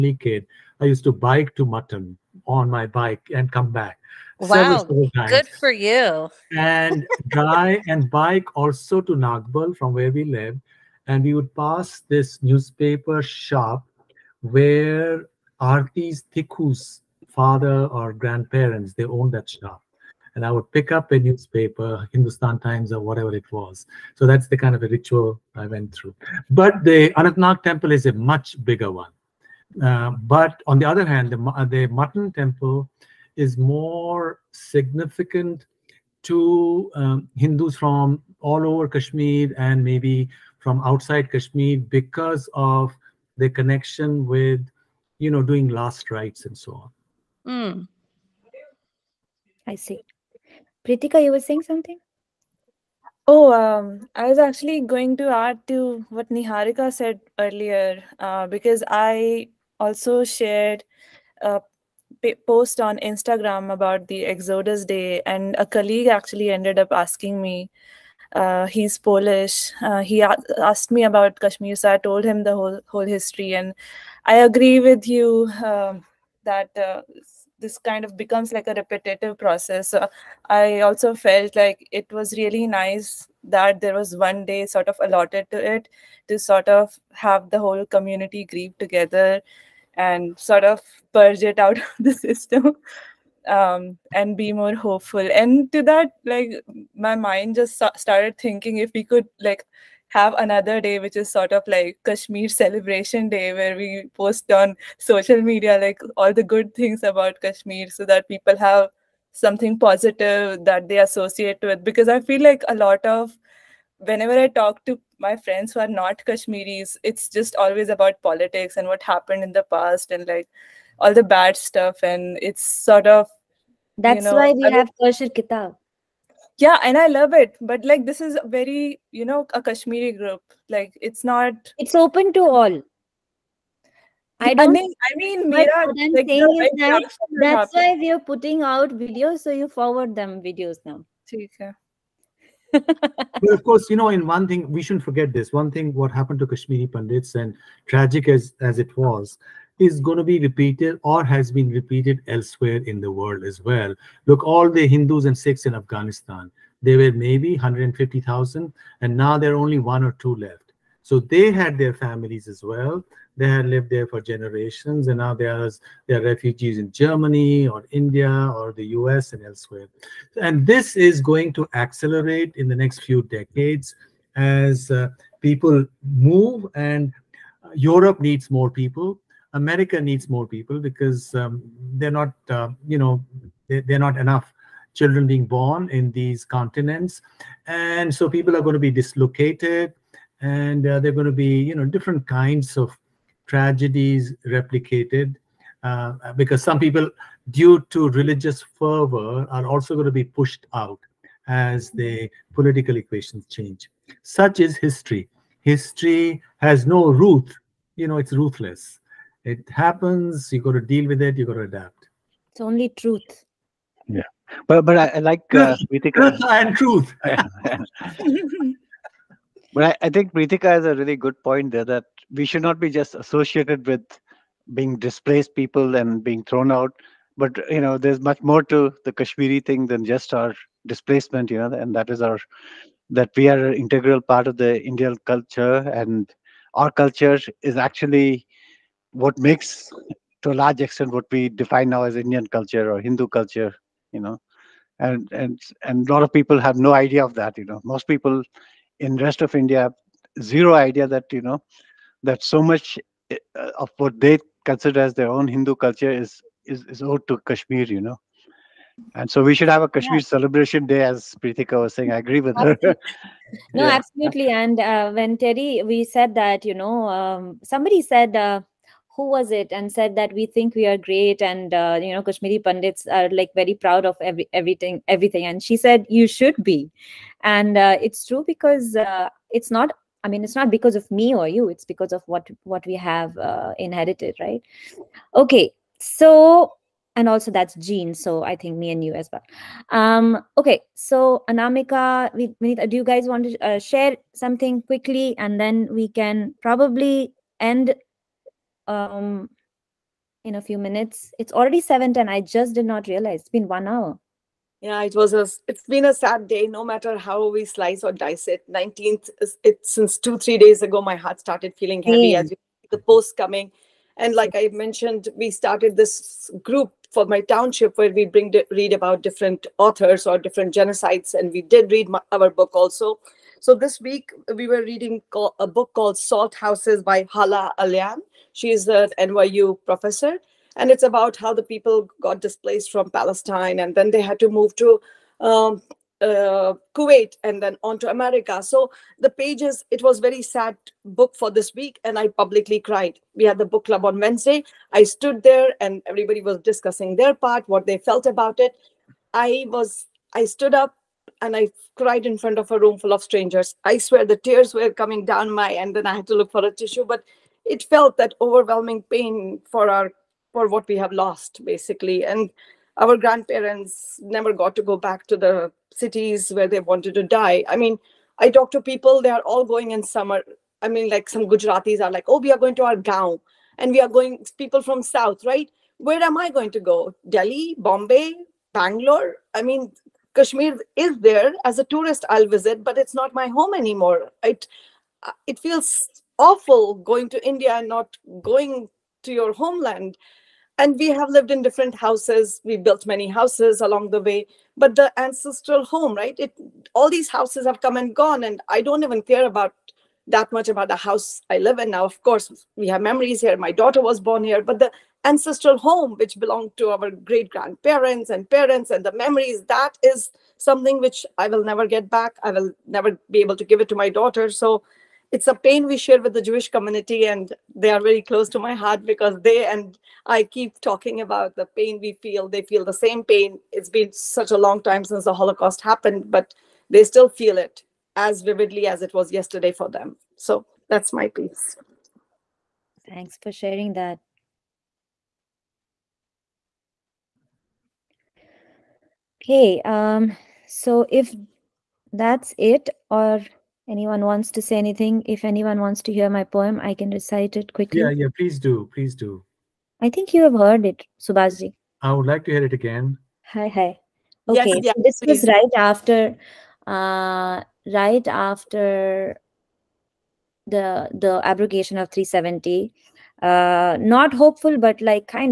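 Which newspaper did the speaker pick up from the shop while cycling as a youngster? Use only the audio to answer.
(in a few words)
Hindustan Times.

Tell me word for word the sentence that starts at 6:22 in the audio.
I'll visit, but it's not my home anymore.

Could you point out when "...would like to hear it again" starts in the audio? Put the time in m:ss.
7:32.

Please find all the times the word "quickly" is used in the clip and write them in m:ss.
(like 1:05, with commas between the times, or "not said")
4:54, 7:27.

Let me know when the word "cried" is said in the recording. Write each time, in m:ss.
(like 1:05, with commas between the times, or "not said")
5:42, 5:51.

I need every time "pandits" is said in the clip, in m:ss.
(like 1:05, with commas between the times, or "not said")
2:26, 4:32.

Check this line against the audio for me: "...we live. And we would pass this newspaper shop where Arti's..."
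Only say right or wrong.
right.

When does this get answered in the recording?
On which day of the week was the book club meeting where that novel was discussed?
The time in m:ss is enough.
5:44.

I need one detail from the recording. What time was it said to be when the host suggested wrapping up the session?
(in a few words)
7:10.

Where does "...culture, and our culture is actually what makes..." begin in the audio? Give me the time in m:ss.
3:55.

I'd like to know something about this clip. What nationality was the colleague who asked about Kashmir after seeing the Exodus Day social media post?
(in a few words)
Polish.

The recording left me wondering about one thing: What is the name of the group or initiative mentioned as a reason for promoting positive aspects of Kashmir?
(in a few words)
Kaeshir Kitaab.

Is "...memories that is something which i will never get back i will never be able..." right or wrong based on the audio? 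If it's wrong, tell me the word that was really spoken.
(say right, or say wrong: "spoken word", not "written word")
right.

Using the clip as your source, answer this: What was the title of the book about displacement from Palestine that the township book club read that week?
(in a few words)
Salt Houses.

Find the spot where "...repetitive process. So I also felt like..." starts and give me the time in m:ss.
1:18.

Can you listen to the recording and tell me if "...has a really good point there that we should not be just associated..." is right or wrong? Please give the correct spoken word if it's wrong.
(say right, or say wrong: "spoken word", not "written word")
right.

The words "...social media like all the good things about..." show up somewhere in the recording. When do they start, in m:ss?
1:44.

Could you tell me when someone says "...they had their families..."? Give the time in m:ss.
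2:41.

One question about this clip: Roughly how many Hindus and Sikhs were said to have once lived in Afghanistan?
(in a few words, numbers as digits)
150,000.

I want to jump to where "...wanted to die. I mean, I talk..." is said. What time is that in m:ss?
6:06.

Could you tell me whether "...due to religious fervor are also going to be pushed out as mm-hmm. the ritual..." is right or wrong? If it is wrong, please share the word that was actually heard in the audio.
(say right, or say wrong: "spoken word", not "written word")
wrong: "political", not "ritual".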